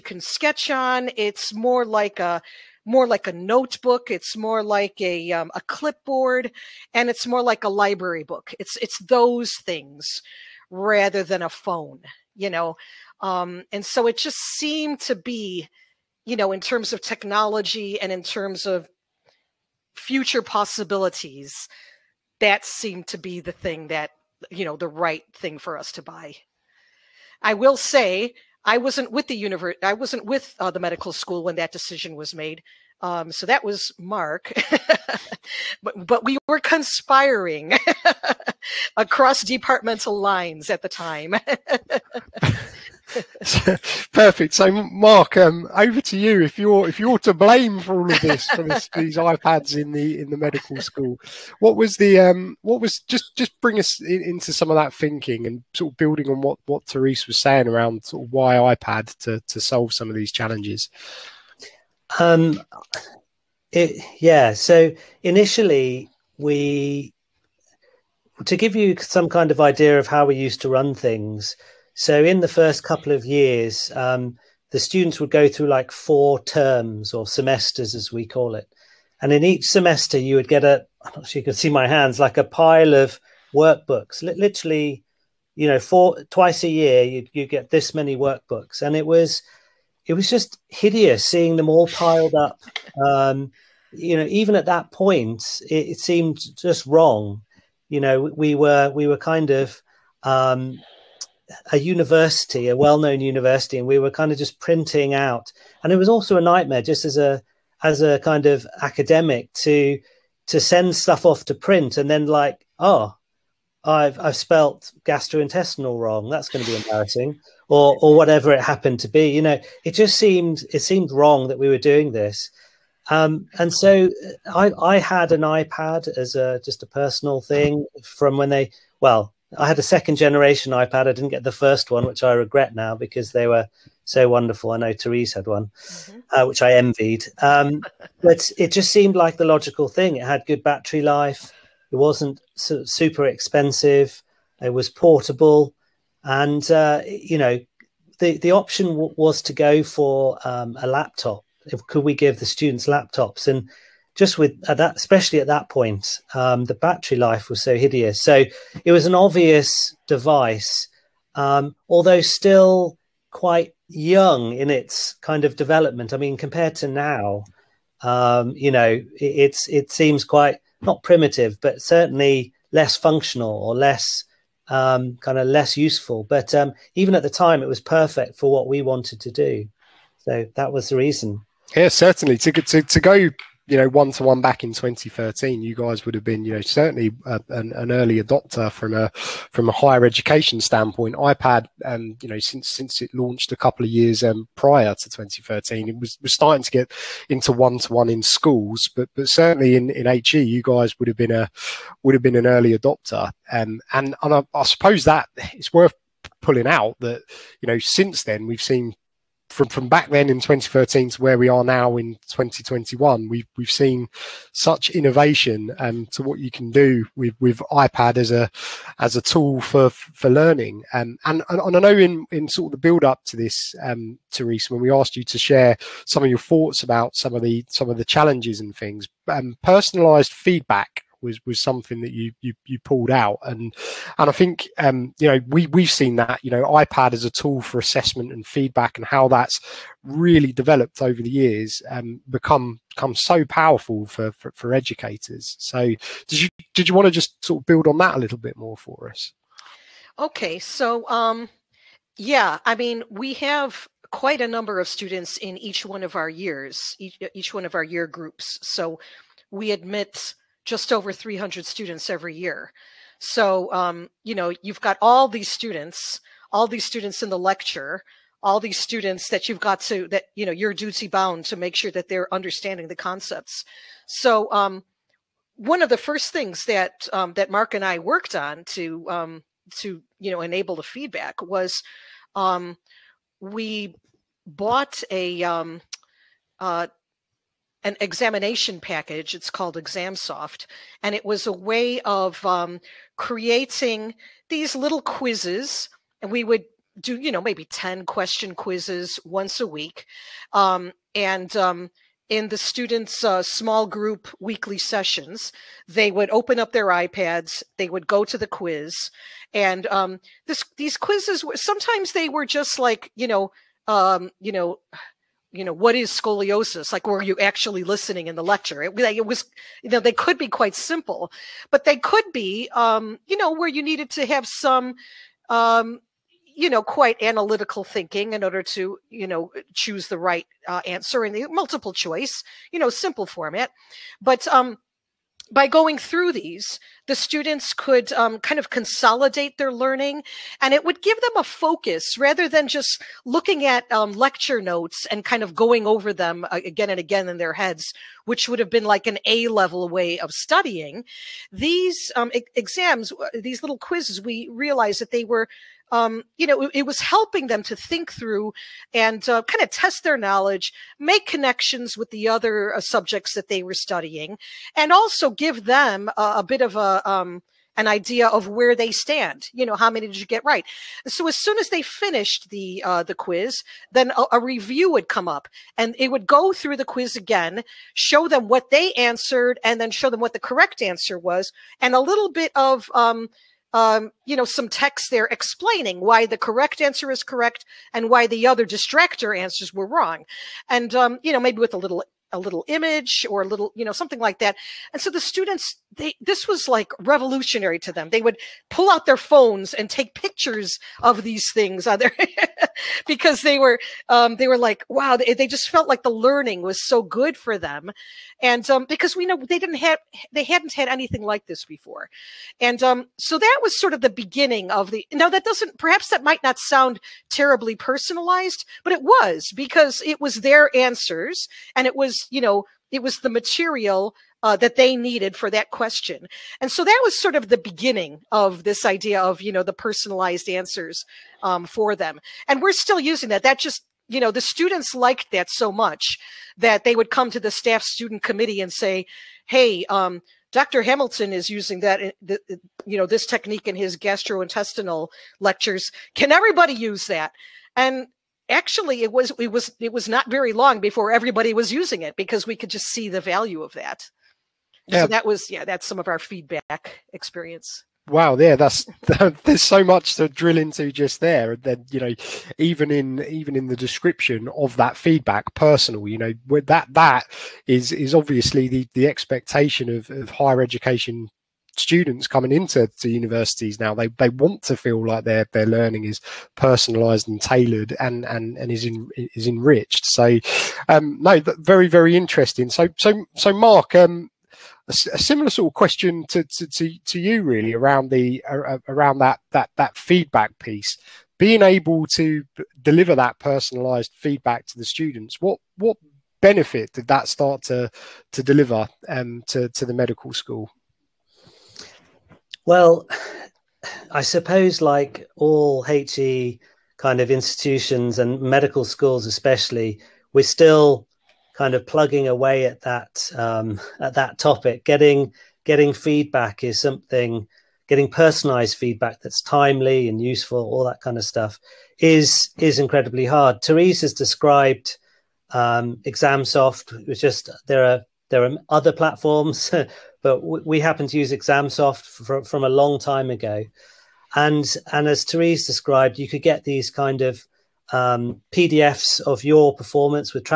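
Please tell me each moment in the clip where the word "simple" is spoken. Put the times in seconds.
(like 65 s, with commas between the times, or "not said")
320 s, 332 s.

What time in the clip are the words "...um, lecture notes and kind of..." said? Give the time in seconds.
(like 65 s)
343 s.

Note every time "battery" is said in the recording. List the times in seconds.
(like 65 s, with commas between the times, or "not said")
140 s, 156 s.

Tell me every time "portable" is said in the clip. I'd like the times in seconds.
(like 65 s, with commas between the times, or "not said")
144 s.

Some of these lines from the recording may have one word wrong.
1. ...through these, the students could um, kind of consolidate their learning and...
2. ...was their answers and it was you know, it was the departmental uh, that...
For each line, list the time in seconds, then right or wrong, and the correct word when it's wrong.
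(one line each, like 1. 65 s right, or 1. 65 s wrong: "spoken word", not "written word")
1. 335 s right
2. 420 s wrong: "material", not "departmental".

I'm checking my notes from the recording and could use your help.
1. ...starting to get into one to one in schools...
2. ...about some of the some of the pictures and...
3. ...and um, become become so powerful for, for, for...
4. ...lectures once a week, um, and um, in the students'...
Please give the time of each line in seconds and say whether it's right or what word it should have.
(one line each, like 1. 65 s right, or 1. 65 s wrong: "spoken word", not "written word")
1. 196 s right
2. 226 s wrong: "challenges", not "pictures"
3. 241 s right
4. 298 s wrong: "quizzes", not "lectures".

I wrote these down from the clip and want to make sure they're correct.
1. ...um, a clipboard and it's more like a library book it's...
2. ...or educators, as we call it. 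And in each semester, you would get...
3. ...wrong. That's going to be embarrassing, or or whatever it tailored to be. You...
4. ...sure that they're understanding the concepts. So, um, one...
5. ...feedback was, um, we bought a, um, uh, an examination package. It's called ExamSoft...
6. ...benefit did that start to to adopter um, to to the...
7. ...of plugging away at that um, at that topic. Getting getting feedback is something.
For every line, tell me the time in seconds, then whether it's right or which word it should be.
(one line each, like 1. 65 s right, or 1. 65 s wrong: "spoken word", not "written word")
1. 5 s right
2. 77 s wrong: "semesters", not "educators"
3. 115 s wrong: "happened", not "tailored"
4. 271 s right
5. 280 s right
6. 496 s wrong: "deliver", not "adopter"
7. 511 s right.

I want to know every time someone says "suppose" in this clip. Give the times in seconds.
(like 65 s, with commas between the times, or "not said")
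204 s, 504 s.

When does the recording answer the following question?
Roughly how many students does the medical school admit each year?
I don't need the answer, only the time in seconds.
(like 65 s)
260 s.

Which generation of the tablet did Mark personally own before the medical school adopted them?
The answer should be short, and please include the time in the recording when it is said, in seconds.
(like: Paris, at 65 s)
Second generation, at 129 s.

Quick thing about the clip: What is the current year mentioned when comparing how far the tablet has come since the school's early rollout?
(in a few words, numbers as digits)
2021.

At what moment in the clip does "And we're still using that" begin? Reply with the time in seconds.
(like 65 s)
432 s.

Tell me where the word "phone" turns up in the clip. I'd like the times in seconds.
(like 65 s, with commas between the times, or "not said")
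11 s, 399 s.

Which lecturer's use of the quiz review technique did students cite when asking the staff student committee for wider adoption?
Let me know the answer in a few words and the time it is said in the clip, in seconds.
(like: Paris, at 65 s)
Dr. Hamilton, at 440 s.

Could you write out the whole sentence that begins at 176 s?
But um, even at the time, it was perfect for what we wanted to do.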